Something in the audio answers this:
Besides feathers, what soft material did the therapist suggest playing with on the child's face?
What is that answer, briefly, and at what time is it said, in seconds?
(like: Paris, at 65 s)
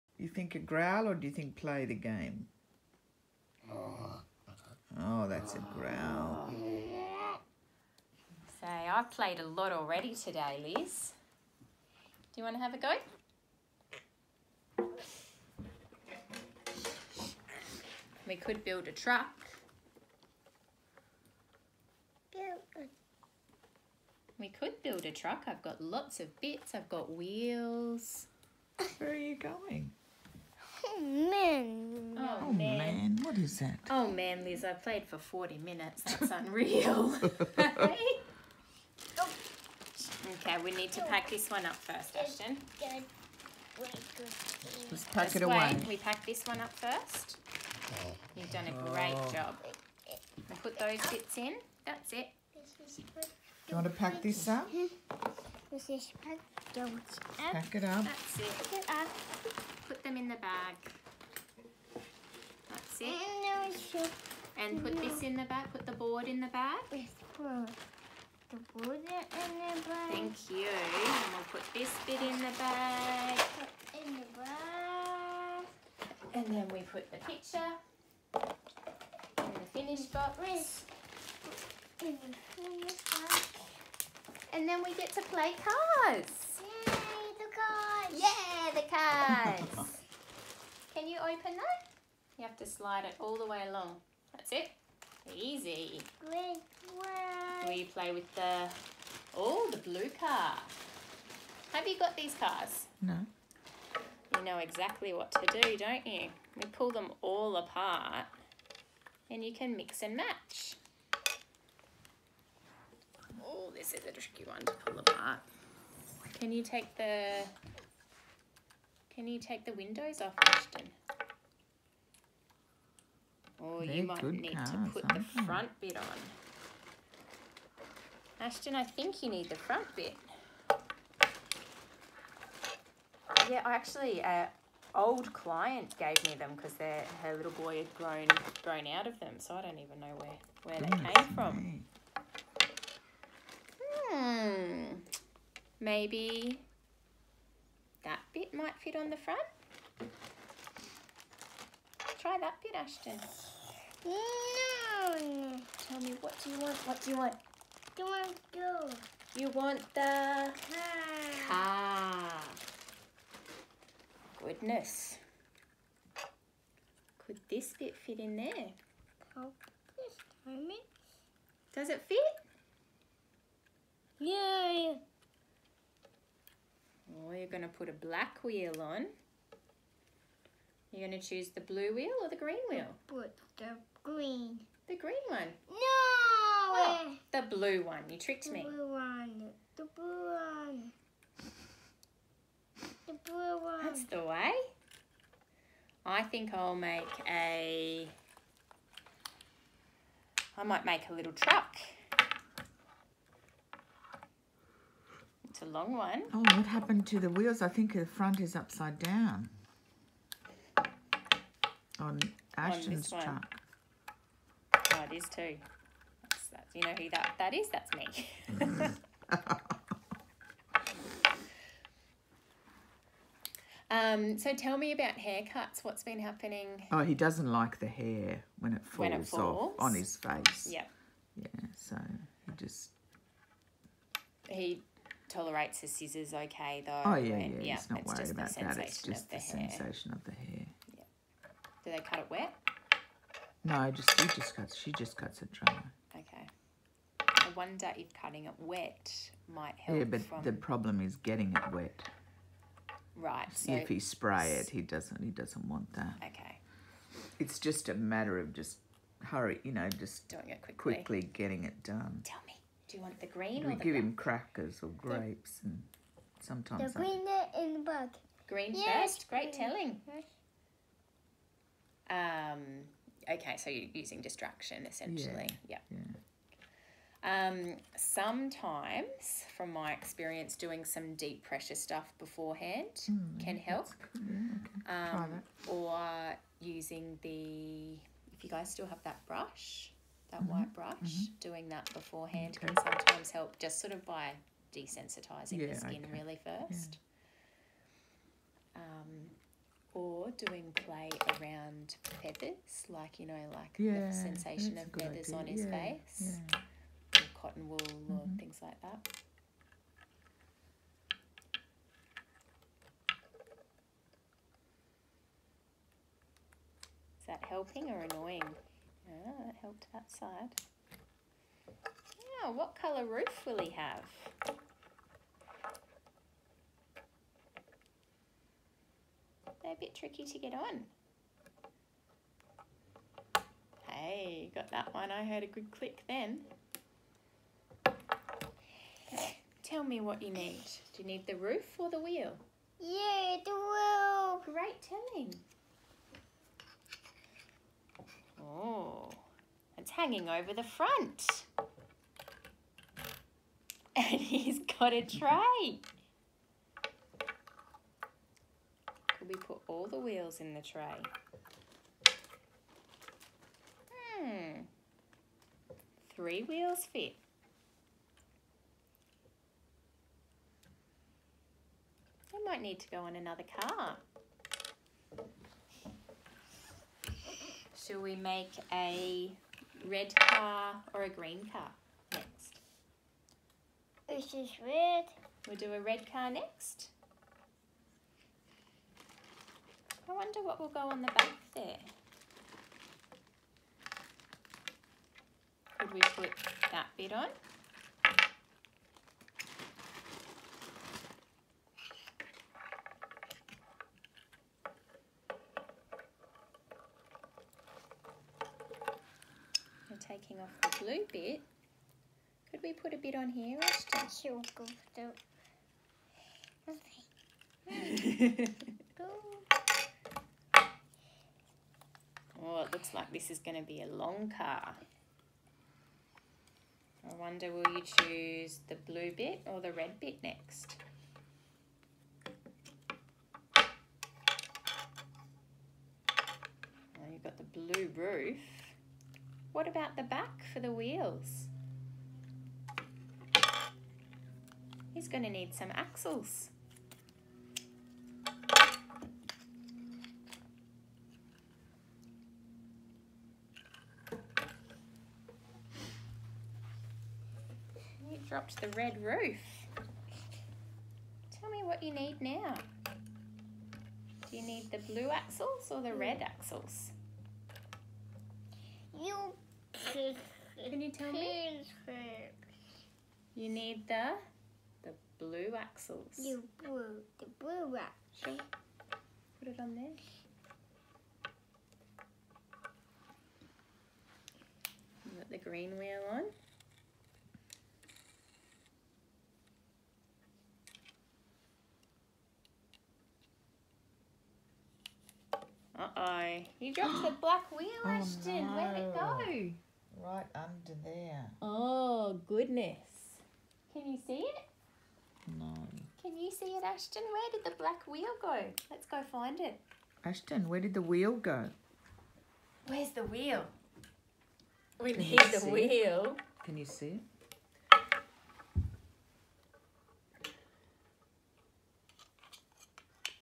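cotton wool, at 307 s.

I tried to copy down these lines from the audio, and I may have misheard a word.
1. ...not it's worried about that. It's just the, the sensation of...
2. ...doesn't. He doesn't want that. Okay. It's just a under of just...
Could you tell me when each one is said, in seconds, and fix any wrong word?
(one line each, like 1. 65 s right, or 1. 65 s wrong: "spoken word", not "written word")
1. 237 s right
2. 254 s wrong: "matter", not "under".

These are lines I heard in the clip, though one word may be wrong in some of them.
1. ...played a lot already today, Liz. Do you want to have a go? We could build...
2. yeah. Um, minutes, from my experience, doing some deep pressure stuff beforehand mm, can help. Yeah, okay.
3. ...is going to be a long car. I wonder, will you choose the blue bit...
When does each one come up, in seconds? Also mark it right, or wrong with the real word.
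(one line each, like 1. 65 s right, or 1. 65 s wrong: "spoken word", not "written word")
1. 9 s right
2. 275 s wrong: "sometimes", not "minutes"
3. 423 s right.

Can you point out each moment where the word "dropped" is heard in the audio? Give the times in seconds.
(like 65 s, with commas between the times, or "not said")
458 s, 496 s.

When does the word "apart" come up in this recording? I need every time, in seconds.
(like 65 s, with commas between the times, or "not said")
107 s, 114 s.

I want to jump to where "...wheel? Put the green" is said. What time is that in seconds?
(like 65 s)
182 s.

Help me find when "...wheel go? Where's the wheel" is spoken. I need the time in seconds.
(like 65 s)
510 s.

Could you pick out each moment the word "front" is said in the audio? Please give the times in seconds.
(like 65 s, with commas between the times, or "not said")
125 s, 129 s, 149 s, 208 s, 350 s.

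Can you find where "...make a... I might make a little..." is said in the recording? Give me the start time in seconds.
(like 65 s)
196 s.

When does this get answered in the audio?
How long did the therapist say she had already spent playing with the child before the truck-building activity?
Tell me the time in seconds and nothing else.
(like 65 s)
35 s.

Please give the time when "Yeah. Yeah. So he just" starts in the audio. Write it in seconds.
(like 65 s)
230 s.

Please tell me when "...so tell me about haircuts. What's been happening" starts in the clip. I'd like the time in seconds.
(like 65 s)
224 s.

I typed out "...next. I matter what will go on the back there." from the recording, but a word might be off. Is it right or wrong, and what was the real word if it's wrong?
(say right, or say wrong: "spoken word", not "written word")
wrong: "wonder", not "matter".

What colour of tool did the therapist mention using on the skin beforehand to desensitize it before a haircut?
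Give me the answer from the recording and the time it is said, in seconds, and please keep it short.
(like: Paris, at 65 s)
white, at 290 s.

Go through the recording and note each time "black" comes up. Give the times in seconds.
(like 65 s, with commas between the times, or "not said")
177 s, 263 s, 497 s, 507 s.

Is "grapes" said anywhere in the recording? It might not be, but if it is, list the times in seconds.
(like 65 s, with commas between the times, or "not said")
264 s.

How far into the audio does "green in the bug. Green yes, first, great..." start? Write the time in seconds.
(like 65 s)
267 s.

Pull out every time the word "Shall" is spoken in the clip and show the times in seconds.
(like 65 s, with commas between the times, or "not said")
377 s.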